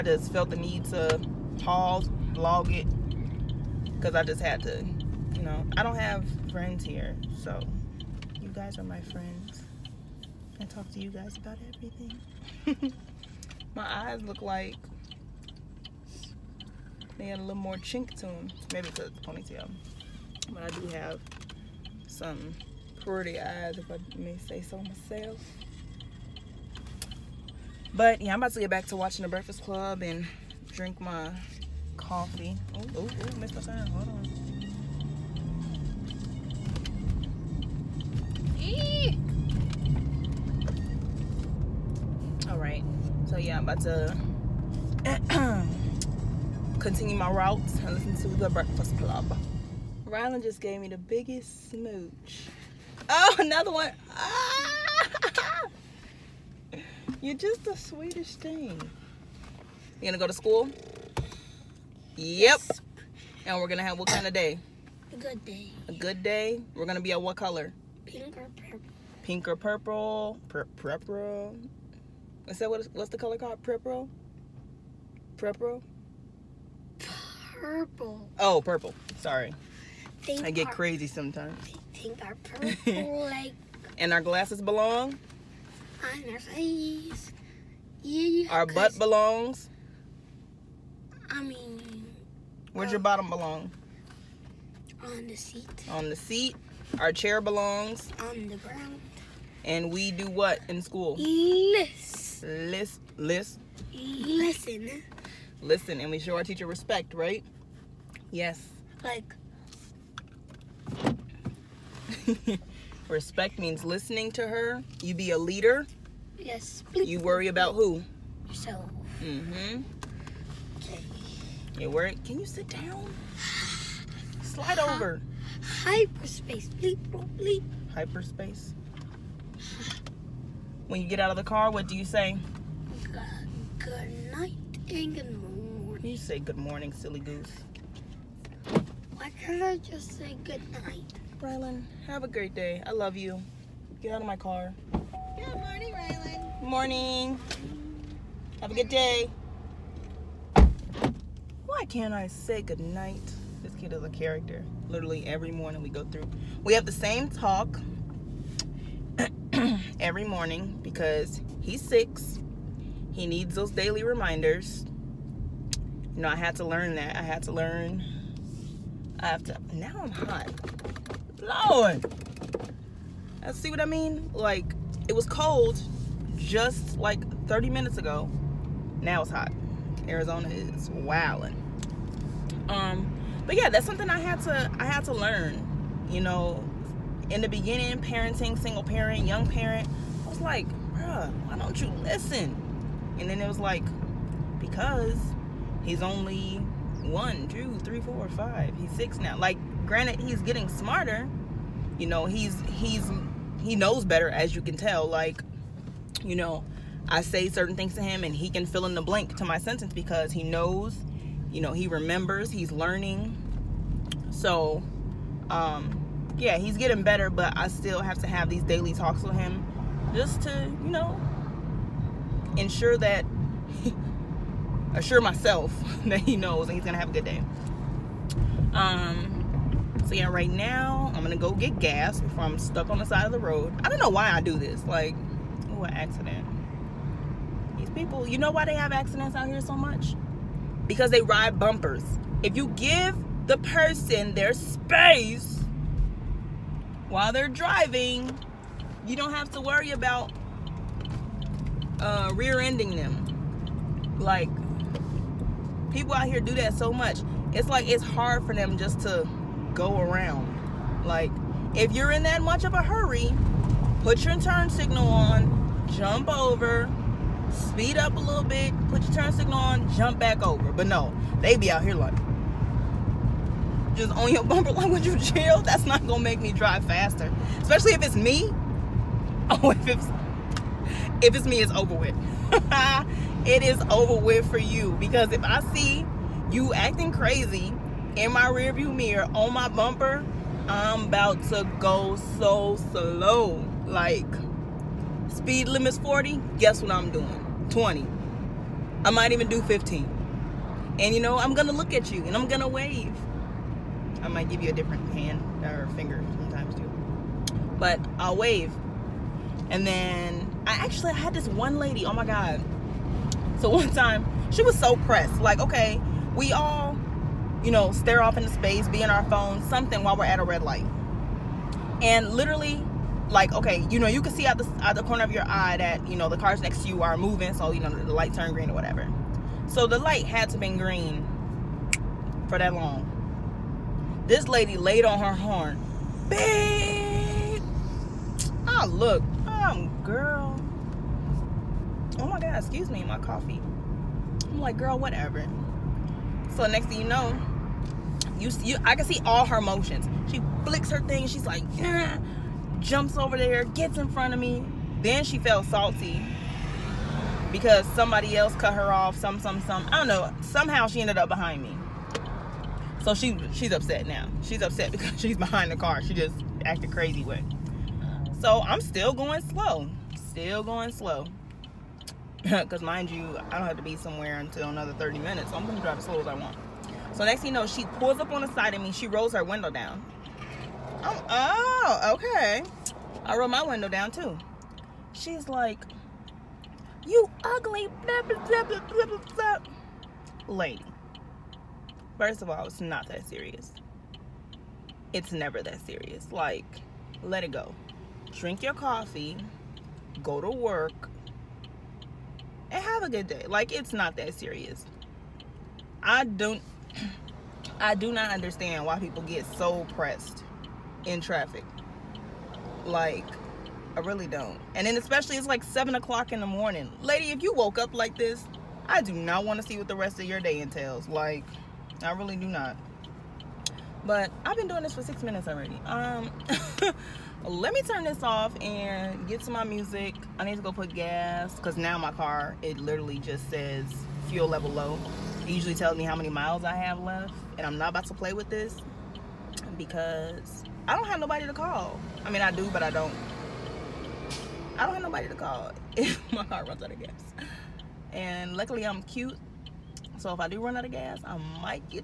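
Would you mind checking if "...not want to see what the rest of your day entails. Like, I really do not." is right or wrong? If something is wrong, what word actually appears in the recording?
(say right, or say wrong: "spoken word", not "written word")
right.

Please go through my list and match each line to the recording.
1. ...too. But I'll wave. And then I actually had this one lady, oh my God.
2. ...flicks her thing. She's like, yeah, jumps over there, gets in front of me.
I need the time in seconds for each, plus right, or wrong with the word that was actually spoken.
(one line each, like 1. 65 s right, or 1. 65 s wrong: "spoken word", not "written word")
1. 306 s right
2. 350 s right.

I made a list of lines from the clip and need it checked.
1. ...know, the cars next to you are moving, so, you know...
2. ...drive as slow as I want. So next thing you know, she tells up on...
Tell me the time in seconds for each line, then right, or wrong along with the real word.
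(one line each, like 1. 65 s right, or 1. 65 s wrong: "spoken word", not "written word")
1. 326 s right
2. 375 s wrong: "pulls", not "tells".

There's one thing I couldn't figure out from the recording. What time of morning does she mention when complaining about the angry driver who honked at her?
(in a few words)
Seven o'clock.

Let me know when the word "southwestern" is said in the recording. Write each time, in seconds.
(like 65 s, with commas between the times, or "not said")
not said.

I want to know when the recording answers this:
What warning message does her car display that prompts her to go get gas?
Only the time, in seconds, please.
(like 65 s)
434 s.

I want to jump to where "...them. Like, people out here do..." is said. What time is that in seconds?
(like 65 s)
252 s.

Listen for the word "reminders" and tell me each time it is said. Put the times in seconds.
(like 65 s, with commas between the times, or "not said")
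164 s.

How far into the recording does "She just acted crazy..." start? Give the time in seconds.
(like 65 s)
366 s.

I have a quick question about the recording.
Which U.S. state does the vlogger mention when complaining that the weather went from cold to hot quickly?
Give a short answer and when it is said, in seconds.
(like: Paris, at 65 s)
Arizona, at 180 s.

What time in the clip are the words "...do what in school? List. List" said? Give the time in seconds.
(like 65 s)
100 s.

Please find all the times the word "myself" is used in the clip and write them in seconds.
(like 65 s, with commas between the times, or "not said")
24 s, 225 s.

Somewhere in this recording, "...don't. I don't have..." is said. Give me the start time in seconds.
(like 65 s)
442 s.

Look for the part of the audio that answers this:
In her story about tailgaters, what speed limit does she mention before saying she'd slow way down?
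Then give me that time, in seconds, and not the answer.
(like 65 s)
295 s.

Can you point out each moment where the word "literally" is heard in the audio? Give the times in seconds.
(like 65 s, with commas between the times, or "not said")
154 s, 322 s, 432 s.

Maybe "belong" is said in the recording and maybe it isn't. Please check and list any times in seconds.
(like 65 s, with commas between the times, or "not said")
84 s, 88 s, 93 s, 97 s.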